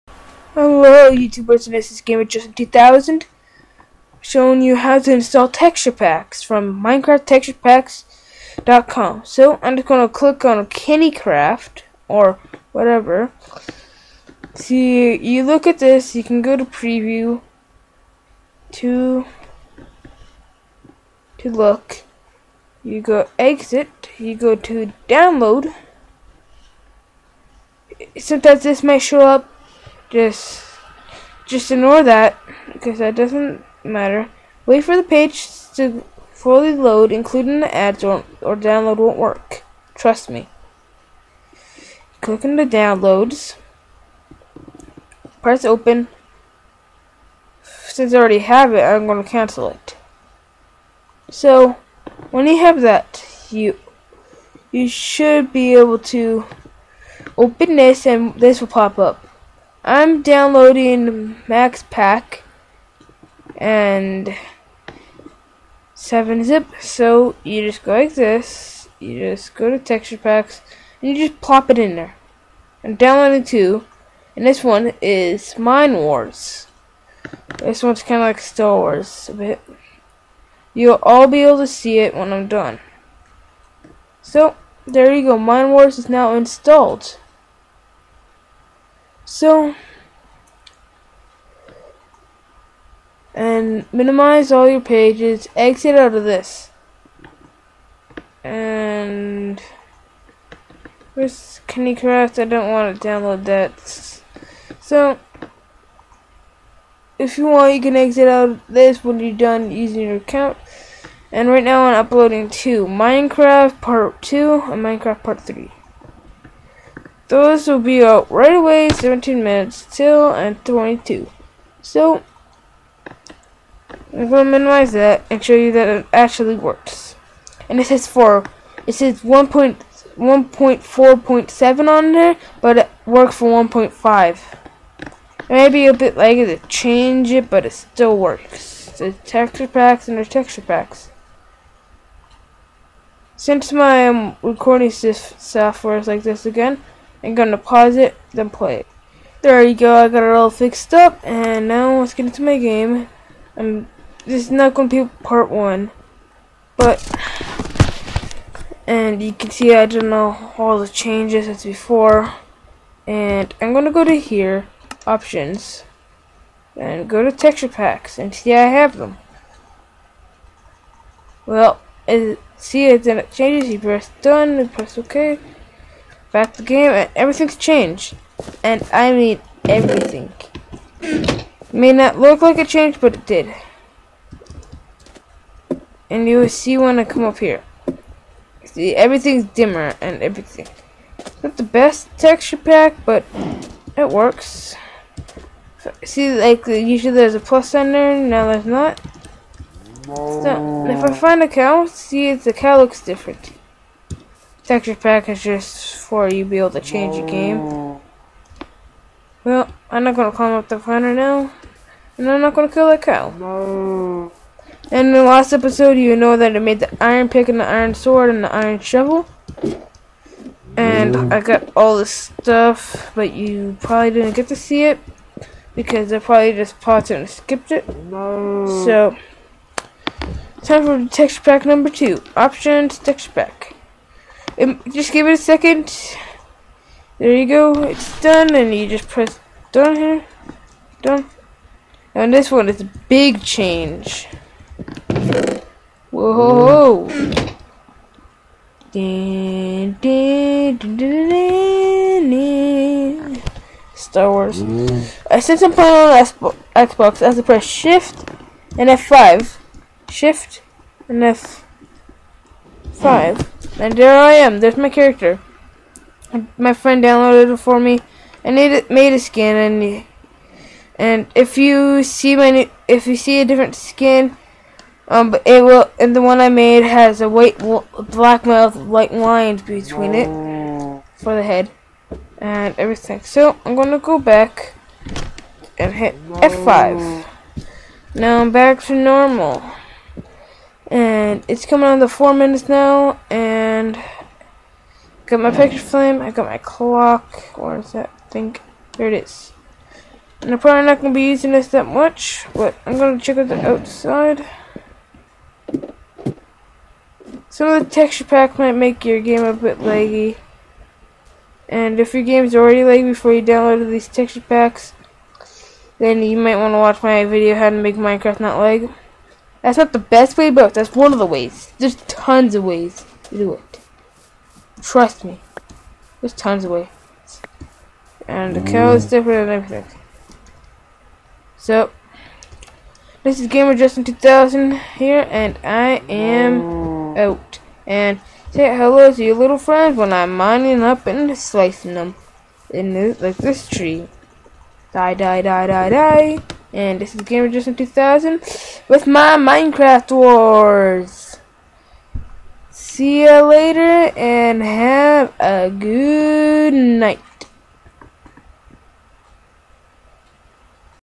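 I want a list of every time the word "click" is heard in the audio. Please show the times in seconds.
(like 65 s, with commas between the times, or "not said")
10 s, 42 s.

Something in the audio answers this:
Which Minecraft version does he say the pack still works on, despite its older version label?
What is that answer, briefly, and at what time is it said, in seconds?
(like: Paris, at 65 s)
1.5, at 133 s.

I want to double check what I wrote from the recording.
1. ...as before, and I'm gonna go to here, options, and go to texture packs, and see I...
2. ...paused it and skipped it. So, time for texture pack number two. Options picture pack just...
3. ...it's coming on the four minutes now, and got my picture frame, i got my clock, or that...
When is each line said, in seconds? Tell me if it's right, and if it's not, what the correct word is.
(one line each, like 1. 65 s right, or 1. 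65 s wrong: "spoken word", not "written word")
1. 161 s right
2. 226 s wrong: "texture", not "picture"
3. 291 s right.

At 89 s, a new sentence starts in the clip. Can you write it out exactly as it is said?
So, and minimize all your pages, exit out of this.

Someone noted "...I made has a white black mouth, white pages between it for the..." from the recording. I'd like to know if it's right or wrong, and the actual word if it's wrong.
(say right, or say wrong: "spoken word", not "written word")
wrong: "lines", not "pages".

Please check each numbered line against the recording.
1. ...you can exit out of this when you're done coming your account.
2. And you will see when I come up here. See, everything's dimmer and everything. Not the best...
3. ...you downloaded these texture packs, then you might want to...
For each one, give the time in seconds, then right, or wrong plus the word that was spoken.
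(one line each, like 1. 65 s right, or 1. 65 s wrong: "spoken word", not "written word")
1. 107 s wrong: "using", not "coming"
2. 186 s right
3. 313 s right.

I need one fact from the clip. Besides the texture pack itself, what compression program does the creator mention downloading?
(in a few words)
7-Zip.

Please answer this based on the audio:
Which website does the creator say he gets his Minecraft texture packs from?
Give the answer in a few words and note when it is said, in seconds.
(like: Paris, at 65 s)
MinecraftTexturePacks.com, at 6 s.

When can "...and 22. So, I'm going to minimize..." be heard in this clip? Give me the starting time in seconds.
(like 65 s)
120 s.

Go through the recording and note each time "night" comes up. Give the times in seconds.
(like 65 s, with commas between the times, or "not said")
356 s.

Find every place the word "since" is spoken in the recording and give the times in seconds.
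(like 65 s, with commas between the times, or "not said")
47 s, 143 s, 255 s.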